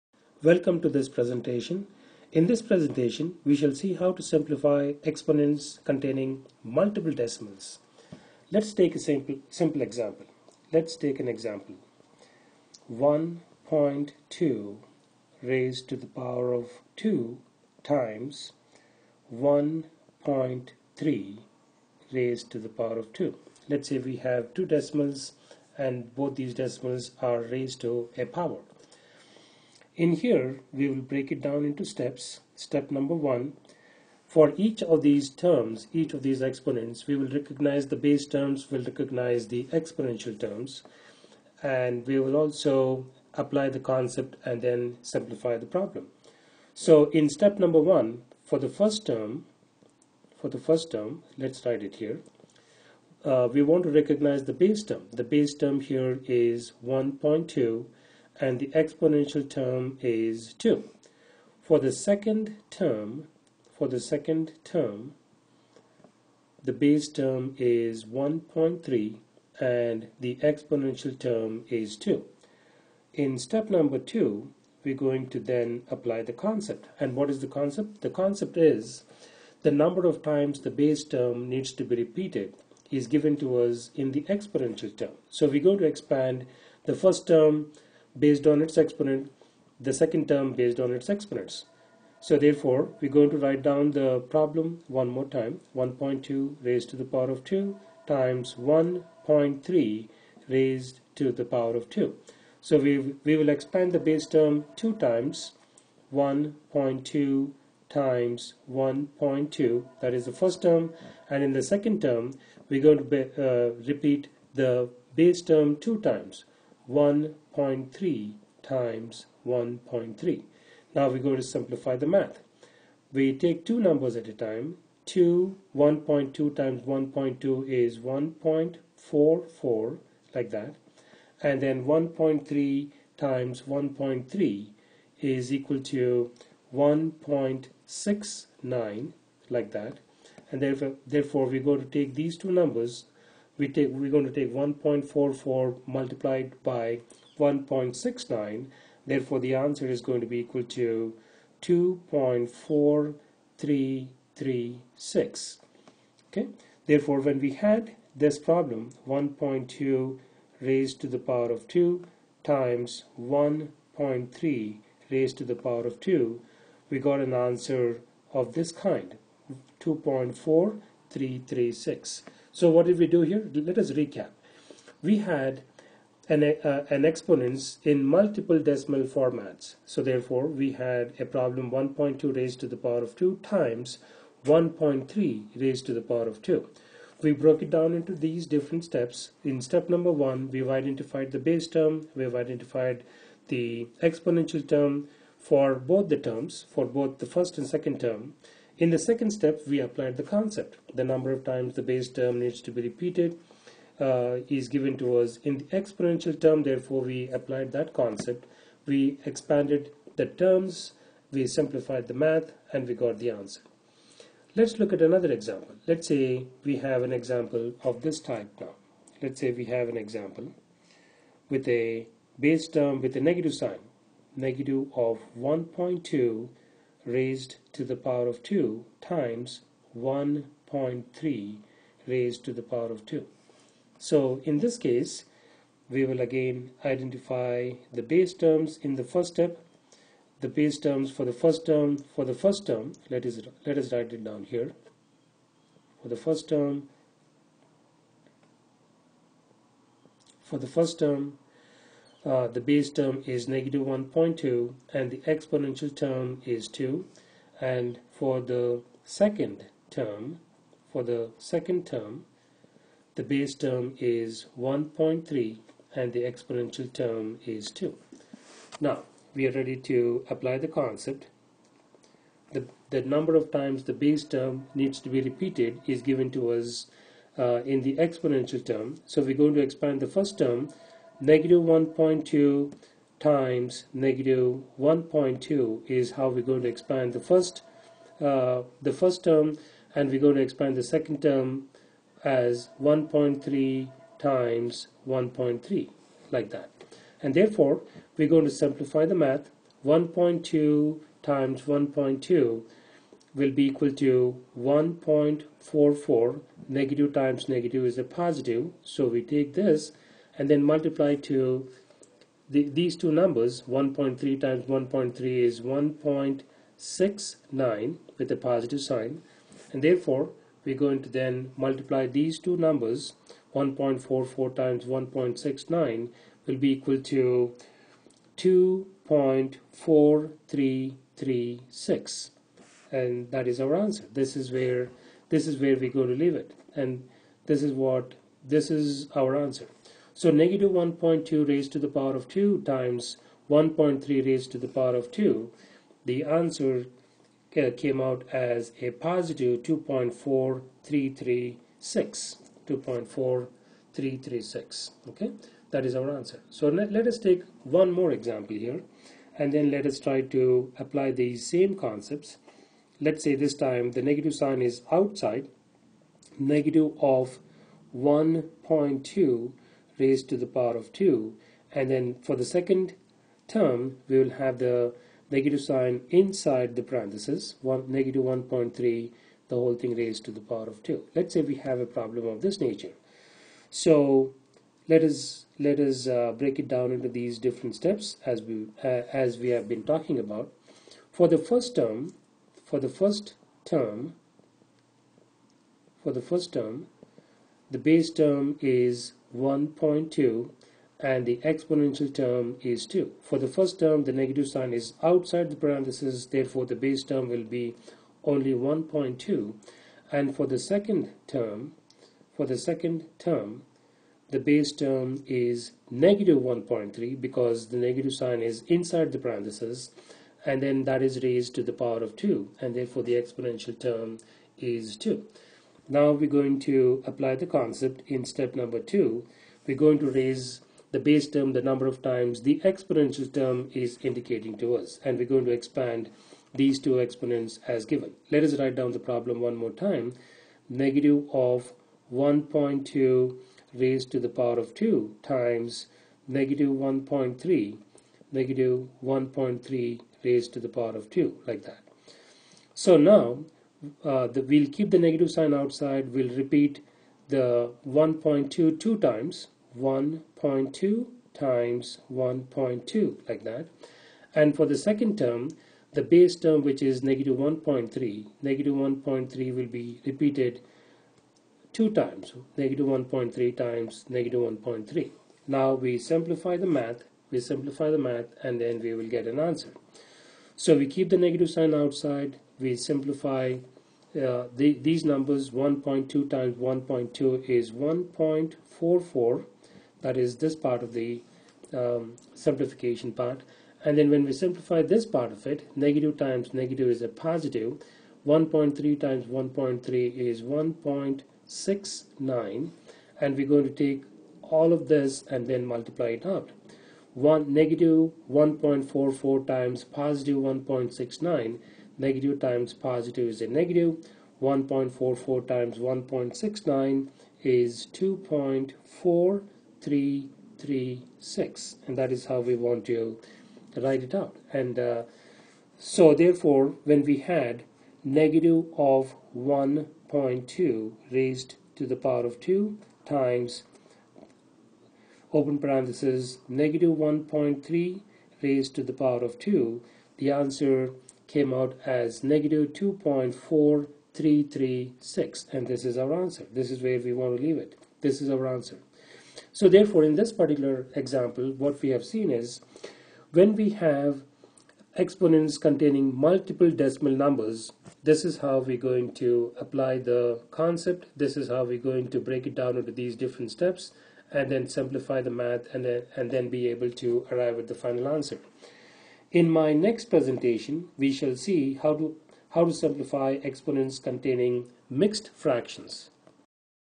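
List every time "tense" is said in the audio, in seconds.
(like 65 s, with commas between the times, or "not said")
not said.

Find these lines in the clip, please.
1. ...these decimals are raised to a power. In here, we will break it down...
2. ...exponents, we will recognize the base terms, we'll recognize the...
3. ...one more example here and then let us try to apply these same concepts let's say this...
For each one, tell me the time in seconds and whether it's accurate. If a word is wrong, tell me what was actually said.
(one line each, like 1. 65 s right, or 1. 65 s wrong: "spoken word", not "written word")
1. 26 s right
2. 36 s right
3. 357 s right.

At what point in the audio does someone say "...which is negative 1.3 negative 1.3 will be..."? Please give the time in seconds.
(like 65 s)
466 s.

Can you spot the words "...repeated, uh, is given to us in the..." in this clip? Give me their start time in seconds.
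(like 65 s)
202 s.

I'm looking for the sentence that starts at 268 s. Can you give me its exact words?
Now, we are ready to apply the concept.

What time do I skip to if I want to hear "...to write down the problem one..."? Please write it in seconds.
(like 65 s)
93 s.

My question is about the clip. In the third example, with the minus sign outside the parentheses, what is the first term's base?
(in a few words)
1.2.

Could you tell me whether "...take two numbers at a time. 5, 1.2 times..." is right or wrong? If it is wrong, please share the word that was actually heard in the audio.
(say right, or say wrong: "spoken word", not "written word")
wrong: "2", not "5".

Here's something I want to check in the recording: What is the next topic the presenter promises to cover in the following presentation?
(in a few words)
mixed fractions.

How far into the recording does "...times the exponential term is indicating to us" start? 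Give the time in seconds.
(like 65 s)
432 s.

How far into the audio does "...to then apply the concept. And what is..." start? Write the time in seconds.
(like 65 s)
75 s.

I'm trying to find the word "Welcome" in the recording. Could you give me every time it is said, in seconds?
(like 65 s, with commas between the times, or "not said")
0 s.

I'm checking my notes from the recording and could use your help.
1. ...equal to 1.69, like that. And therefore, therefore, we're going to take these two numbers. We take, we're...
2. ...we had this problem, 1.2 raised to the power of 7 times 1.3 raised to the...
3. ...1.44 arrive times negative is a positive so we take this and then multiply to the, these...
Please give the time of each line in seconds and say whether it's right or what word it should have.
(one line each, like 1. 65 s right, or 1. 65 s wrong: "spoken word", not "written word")
1. 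135 s right
2. 157 s wrong: "2", not "7"
3. 304 s wrong: "negative", not "arrive".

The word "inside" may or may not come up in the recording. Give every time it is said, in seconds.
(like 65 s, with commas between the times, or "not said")
376 s, 418 s.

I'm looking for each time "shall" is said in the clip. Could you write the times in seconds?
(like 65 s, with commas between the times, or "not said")
3 s, 571 s.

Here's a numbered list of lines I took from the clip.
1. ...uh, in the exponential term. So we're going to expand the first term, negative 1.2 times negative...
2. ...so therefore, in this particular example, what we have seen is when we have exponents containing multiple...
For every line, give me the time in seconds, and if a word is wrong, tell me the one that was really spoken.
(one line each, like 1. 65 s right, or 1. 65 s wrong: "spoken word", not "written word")
1. 277 s right
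2. 549 s right.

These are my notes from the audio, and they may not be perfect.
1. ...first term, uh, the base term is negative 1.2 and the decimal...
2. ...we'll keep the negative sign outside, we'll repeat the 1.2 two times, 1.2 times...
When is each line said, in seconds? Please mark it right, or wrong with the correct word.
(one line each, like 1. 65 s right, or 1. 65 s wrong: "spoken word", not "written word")
1. 250 s wrong: "exponential", not "decimal"
2. 454 s right.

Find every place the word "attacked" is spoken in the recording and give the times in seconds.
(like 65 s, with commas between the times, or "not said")
not said.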